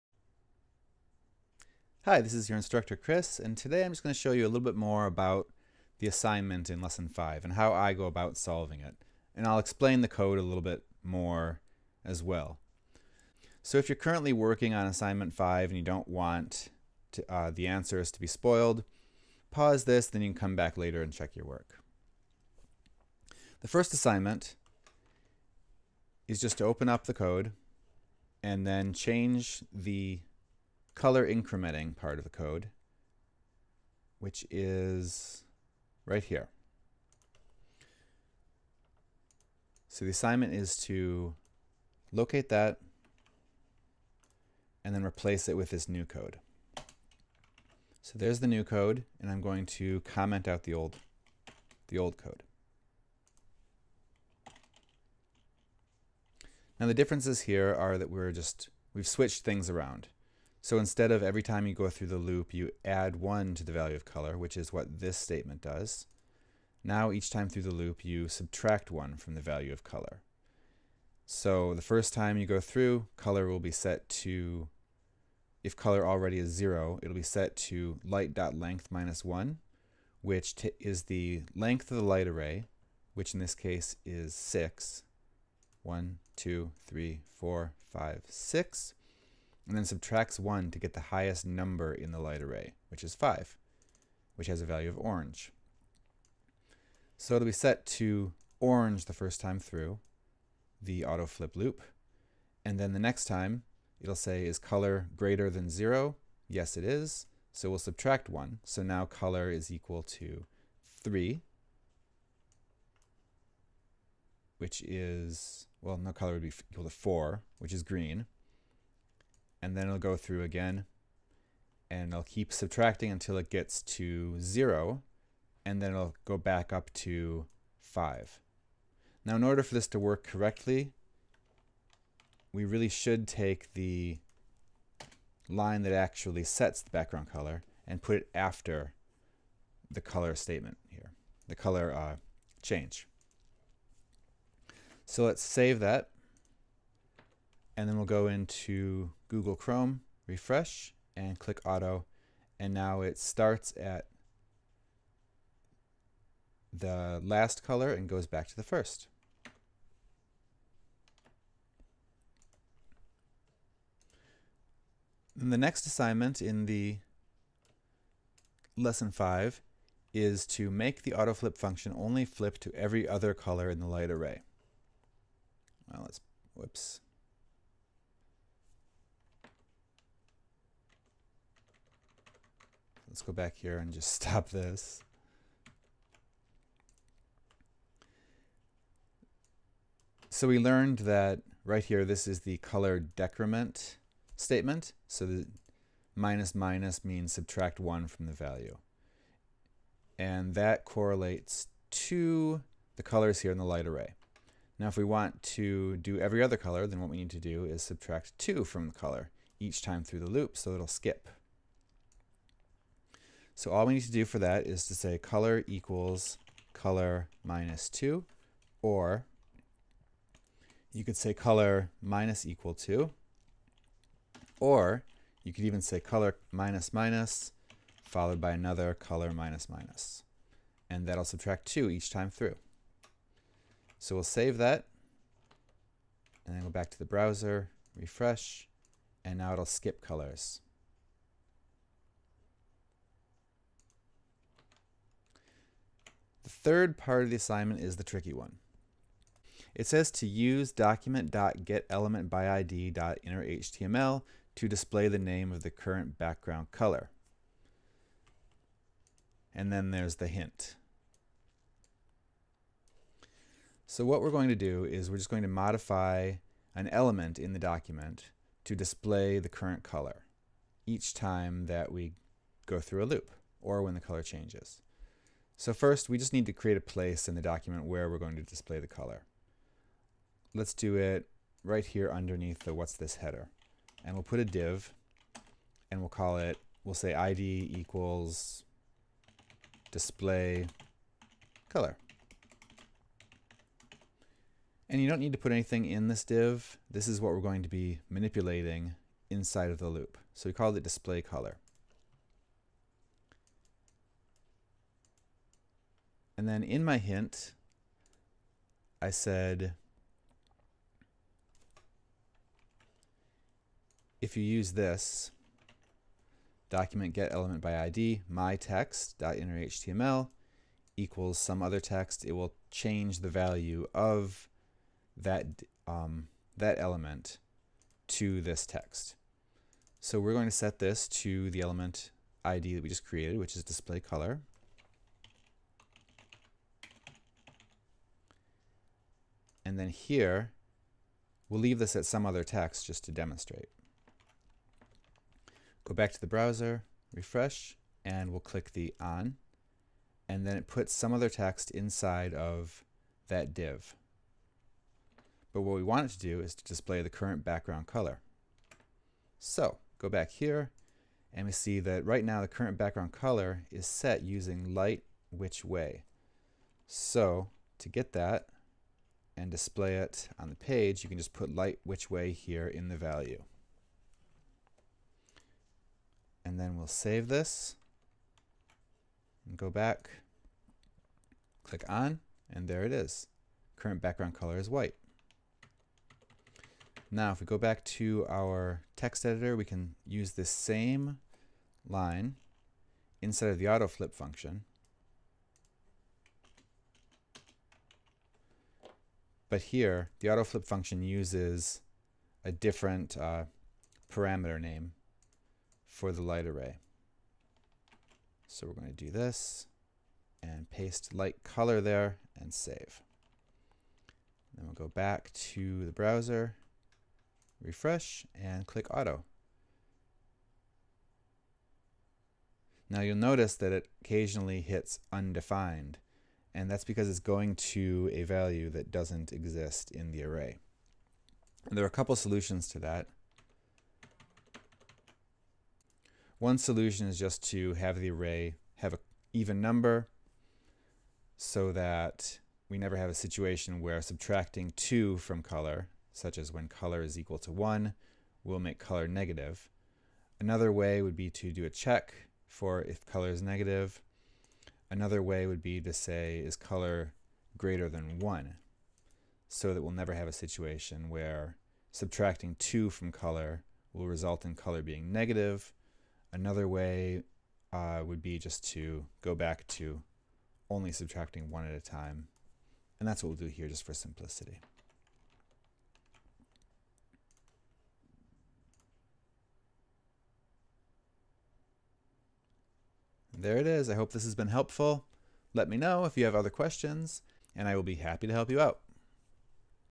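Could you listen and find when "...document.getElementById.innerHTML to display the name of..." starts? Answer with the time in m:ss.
4:10.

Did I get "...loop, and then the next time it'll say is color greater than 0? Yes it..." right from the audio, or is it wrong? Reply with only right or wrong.
right.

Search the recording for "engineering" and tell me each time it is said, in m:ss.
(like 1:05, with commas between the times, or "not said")
not said.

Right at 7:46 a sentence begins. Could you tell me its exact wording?
Another way uh, would be just to go back to only subtracting 1 at a time.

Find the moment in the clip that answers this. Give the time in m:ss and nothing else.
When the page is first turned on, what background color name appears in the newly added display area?
6:24.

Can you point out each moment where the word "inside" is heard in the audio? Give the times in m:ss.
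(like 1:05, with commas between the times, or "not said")
4:59, 5:51, 6:33.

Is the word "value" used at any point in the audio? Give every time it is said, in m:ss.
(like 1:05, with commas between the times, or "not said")
1:03, 1:09, 1:34, 3:18, 5:23, 6:12, 7:08.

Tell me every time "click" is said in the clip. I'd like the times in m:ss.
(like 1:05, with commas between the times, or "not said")
2:31, 5:48, 6:21, 6:58.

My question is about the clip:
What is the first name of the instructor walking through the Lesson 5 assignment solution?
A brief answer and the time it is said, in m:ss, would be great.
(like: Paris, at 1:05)
Chris, at 0:02.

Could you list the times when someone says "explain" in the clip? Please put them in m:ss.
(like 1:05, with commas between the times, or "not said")
0:09.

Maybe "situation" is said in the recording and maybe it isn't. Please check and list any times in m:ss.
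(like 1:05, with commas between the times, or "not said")
7:23, 7:40.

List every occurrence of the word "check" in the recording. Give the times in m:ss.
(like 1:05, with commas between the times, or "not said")
0:21, 7:31.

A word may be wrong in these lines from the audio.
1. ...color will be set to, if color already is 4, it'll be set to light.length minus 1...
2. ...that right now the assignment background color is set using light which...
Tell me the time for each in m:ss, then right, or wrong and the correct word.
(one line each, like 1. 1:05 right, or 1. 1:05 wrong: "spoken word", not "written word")
1. 1:13 wrong: "0", not "4"
2. 6:01 wrong: "current", not "assignment".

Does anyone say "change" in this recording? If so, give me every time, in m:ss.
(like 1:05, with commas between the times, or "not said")
0:28, 2:22, 4:34, 5:22.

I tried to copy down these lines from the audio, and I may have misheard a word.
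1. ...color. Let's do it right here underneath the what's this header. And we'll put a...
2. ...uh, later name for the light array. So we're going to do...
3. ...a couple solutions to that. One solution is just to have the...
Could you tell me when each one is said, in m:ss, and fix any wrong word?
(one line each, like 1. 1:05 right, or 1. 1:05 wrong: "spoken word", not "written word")
1. 4:38 right
2. 6:43 wrong: "parameter", not "later"
3. 7:11 right.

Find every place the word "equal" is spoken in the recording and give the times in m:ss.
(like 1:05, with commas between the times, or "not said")
1:49, 1:56, 3:35, 3:42, 4:47, 5:20, 7:27.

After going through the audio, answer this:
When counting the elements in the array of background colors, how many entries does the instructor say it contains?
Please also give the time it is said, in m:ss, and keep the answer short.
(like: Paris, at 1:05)
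6, at 1:24.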